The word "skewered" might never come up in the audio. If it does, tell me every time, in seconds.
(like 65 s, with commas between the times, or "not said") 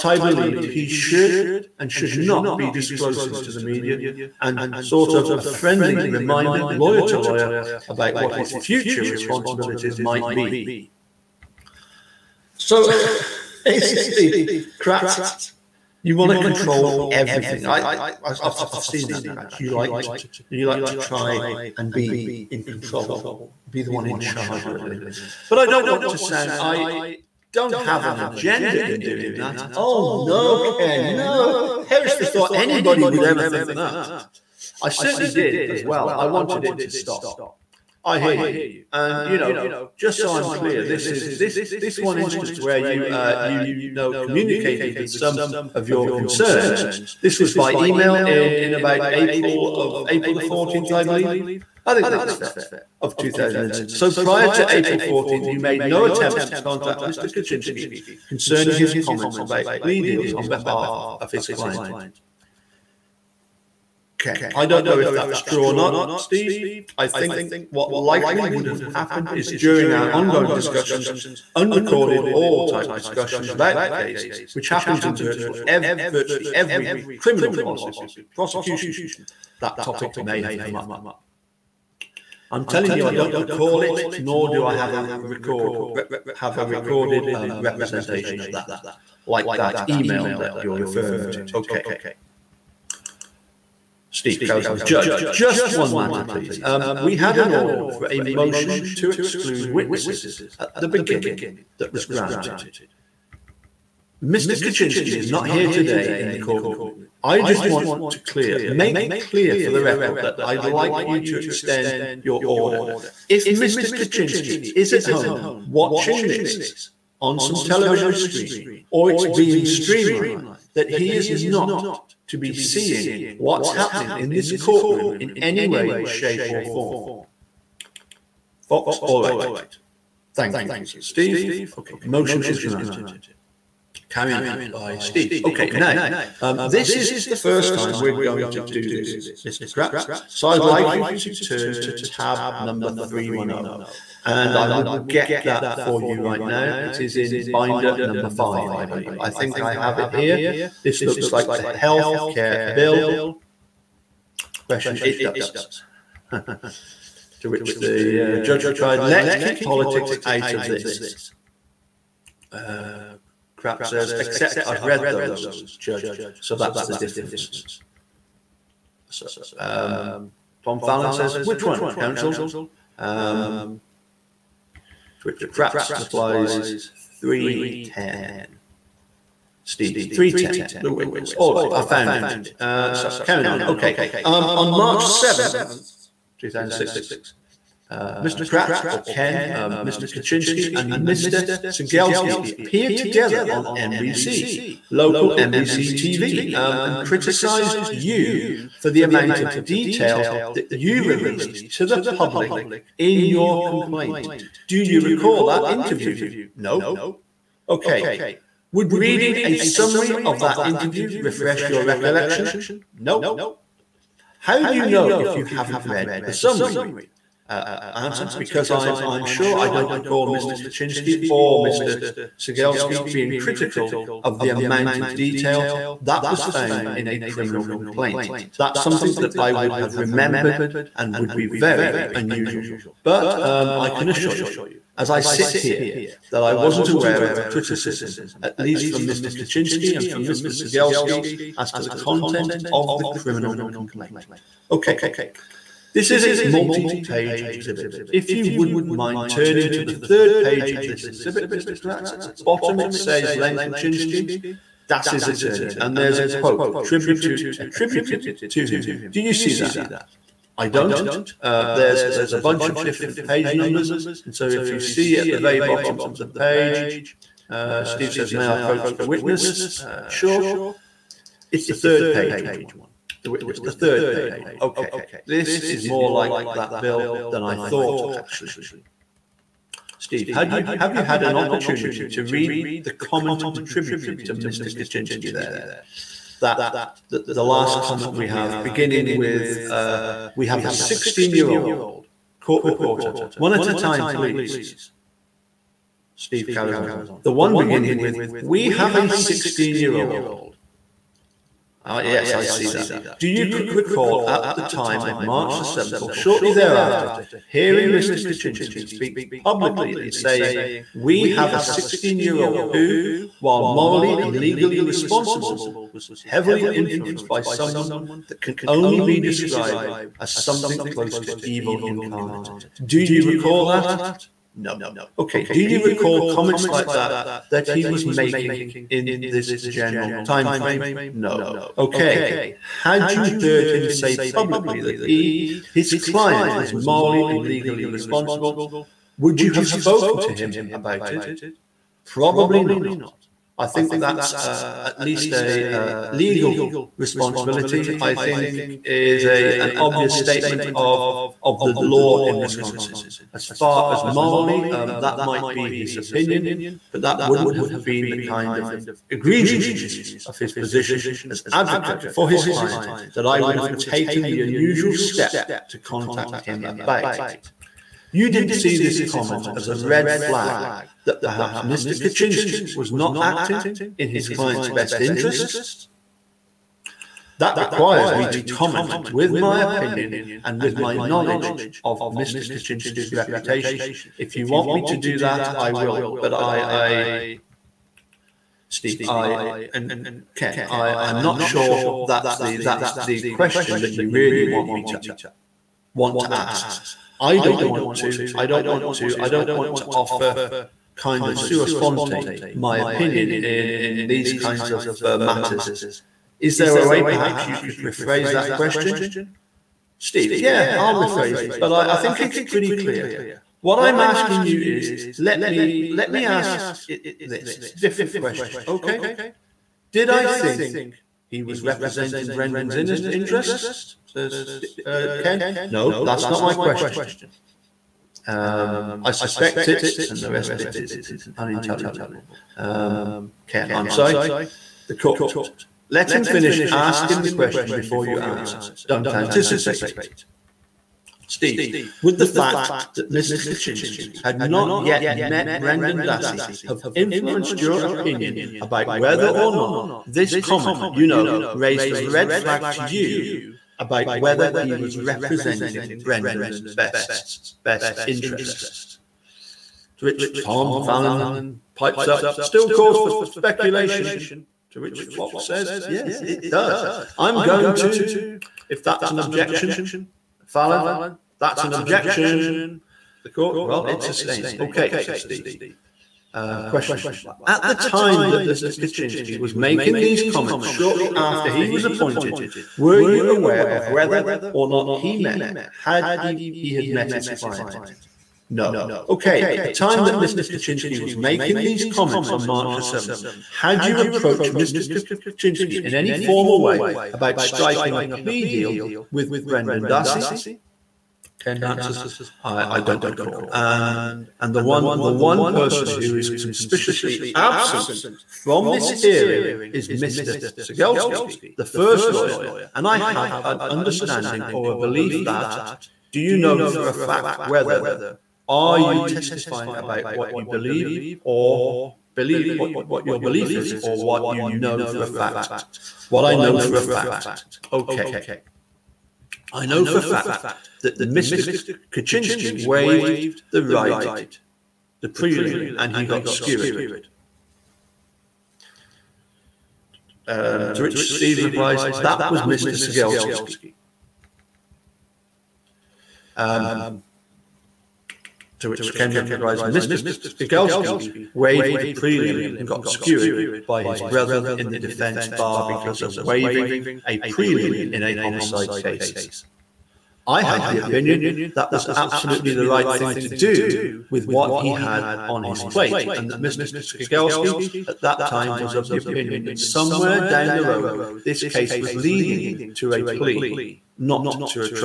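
536 s, 552 s.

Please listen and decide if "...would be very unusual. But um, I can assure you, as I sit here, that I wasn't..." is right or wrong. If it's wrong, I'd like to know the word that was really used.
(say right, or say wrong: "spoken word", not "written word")
right.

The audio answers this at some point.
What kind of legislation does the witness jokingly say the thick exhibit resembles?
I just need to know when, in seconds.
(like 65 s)
151 s.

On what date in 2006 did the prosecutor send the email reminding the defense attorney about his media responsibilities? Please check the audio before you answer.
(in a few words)
April 14th.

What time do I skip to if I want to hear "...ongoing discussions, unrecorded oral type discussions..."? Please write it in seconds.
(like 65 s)
70 s.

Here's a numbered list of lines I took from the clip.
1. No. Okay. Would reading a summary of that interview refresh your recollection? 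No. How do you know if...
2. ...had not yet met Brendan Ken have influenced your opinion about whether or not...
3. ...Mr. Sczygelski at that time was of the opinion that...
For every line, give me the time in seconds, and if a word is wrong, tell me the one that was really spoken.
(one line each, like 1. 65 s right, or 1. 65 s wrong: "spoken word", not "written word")
1. 206 s right
2. 444 s wrong: "Dassey", not "Ken"
3. 566 s right.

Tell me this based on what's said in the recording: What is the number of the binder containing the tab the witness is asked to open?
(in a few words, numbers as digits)
5.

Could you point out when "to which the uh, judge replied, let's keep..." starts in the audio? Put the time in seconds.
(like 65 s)
156 s.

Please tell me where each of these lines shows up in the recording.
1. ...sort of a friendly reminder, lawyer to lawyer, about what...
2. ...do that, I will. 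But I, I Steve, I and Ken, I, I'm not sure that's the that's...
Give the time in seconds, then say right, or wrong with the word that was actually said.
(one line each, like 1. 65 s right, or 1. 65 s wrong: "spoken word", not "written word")
1. 4 s right
2. 384 s right.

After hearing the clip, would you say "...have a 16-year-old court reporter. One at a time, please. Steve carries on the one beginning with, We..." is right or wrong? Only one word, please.
right.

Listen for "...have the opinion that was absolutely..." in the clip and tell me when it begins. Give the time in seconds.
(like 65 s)
560 s.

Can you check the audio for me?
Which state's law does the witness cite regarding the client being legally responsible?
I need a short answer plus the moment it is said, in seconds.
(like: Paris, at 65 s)
Wisconsin, at 352 s.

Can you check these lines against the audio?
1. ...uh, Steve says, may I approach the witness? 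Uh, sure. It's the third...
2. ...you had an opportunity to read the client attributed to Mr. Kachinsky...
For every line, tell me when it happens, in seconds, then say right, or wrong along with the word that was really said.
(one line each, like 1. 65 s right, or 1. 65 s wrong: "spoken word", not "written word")
1. 267 s right
2. 280 s wrong: "comment", not "client".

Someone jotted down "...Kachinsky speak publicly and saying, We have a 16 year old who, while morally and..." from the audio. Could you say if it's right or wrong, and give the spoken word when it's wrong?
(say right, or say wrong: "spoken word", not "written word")
right.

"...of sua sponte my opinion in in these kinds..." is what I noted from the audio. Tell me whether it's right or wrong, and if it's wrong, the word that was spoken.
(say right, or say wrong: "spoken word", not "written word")
right.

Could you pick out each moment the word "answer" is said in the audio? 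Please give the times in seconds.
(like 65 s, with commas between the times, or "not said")
217 s, 438 s, 501 s.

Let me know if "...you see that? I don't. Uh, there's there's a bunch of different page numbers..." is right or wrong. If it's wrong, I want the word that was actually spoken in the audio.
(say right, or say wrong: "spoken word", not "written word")
right.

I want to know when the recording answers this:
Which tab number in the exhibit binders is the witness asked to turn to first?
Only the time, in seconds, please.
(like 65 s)
141 s.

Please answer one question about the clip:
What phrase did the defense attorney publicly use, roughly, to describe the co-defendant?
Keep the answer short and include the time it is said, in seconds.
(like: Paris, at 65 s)
evil incarnate, at 321 s.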